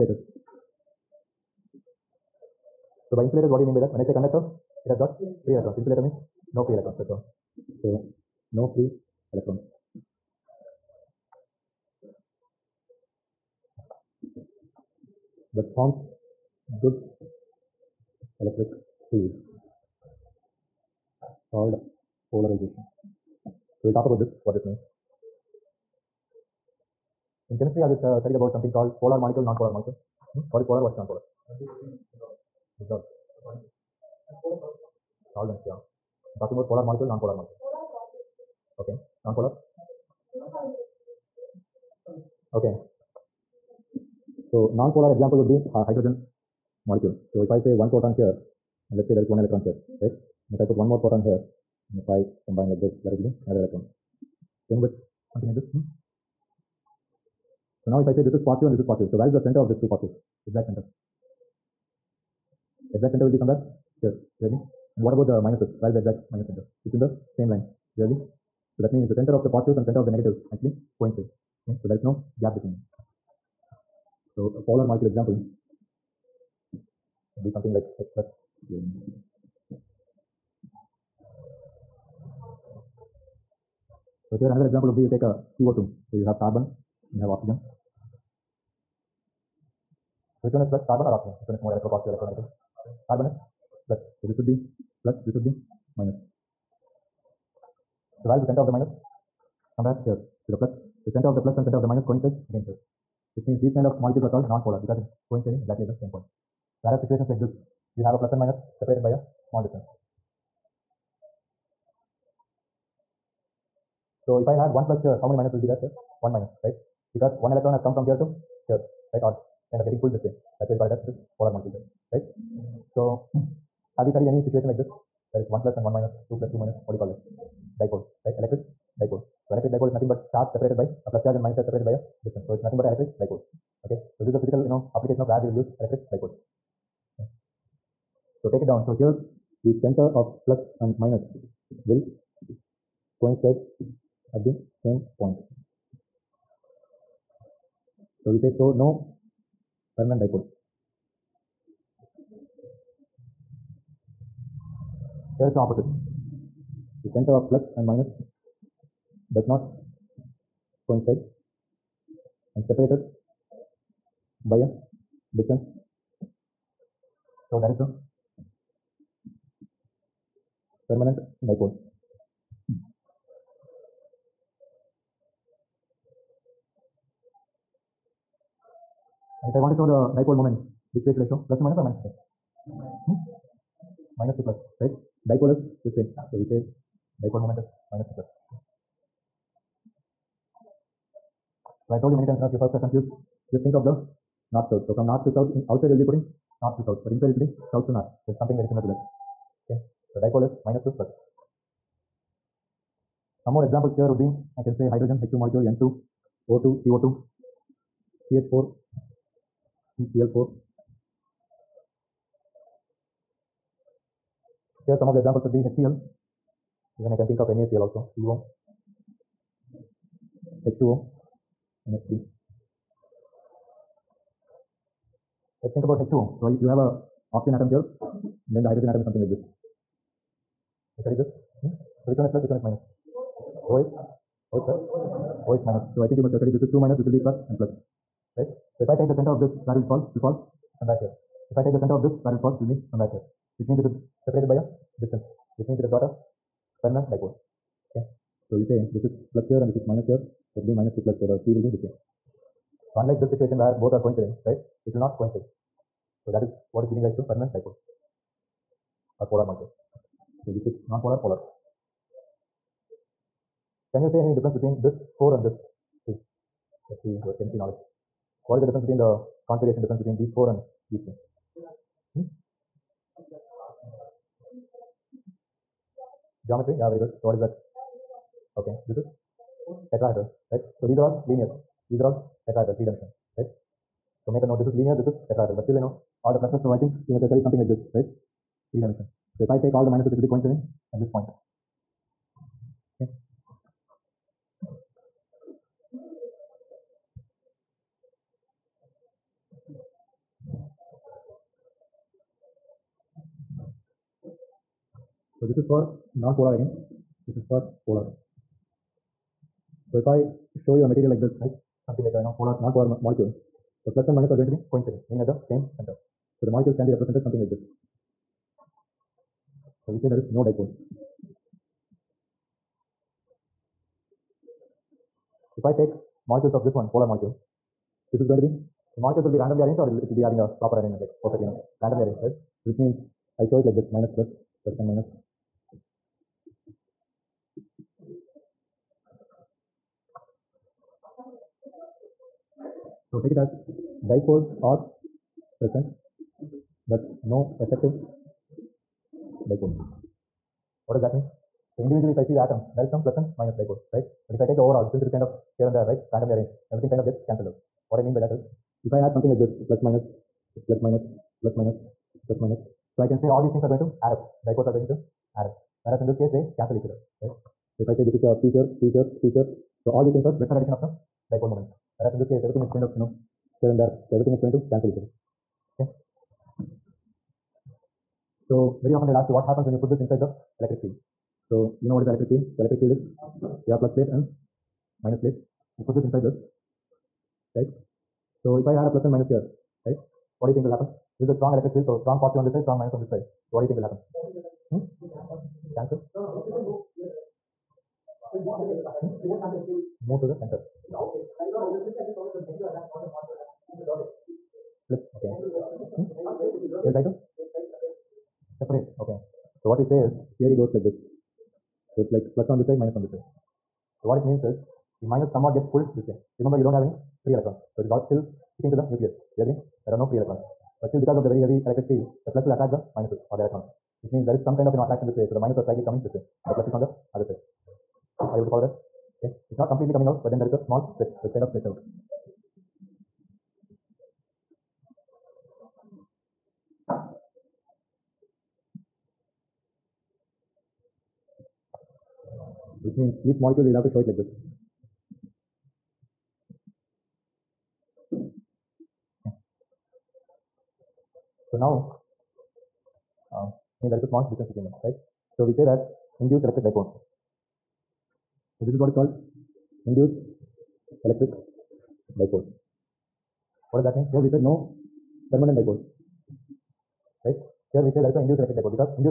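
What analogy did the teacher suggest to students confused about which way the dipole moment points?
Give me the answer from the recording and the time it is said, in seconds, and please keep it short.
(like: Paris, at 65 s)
North south, at 193 s.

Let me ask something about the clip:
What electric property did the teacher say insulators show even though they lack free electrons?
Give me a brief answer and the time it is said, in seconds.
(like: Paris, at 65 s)
Polarization, at 22 s.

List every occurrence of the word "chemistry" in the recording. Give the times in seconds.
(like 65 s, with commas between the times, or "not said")
27 s, 267 s.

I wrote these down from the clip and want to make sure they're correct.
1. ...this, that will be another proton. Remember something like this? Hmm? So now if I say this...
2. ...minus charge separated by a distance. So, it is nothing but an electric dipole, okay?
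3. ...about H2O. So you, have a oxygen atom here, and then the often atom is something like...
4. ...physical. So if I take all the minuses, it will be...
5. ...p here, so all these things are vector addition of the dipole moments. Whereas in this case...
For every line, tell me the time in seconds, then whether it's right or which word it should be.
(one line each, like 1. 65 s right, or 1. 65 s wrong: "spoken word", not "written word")
1. 52 s wrong: "electron", not "proton"
2. 131 s right
3. 225 s wrong: "hydrogen", not "often"
4. 288 s wrong: "dimensional", not "physical"
5. 369 s right.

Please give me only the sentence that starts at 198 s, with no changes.
So it's something very similar to that.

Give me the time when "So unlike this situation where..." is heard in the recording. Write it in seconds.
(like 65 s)
252 s.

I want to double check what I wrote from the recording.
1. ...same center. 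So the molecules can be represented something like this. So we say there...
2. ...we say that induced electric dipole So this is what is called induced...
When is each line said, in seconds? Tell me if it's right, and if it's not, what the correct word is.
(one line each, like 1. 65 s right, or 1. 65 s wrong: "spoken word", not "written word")
1. 315 s right
2. 455 s right.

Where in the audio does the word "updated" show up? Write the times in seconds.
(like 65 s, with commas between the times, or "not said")
not said.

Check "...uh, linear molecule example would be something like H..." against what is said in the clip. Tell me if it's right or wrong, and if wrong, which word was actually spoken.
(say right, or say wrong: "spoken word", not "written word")
wrong: "polar", not "linear".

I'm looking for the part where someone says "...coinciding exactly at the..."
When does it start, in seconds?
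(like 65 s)
105 s.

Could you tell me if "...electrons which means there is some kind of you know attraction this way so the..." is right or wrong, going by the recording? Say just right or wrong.
right.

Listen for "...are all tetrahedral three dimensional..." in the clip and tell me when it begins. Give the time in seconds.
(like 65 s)
282 s.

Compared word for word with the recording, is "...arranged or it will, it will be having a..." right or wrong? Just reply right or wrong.
right.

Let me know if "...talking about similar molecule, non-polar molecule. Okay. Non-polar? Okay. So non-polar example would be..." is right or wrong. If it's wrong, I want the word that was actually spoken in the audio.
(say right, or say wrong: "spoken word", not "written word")
wrong: "polar", not "similar".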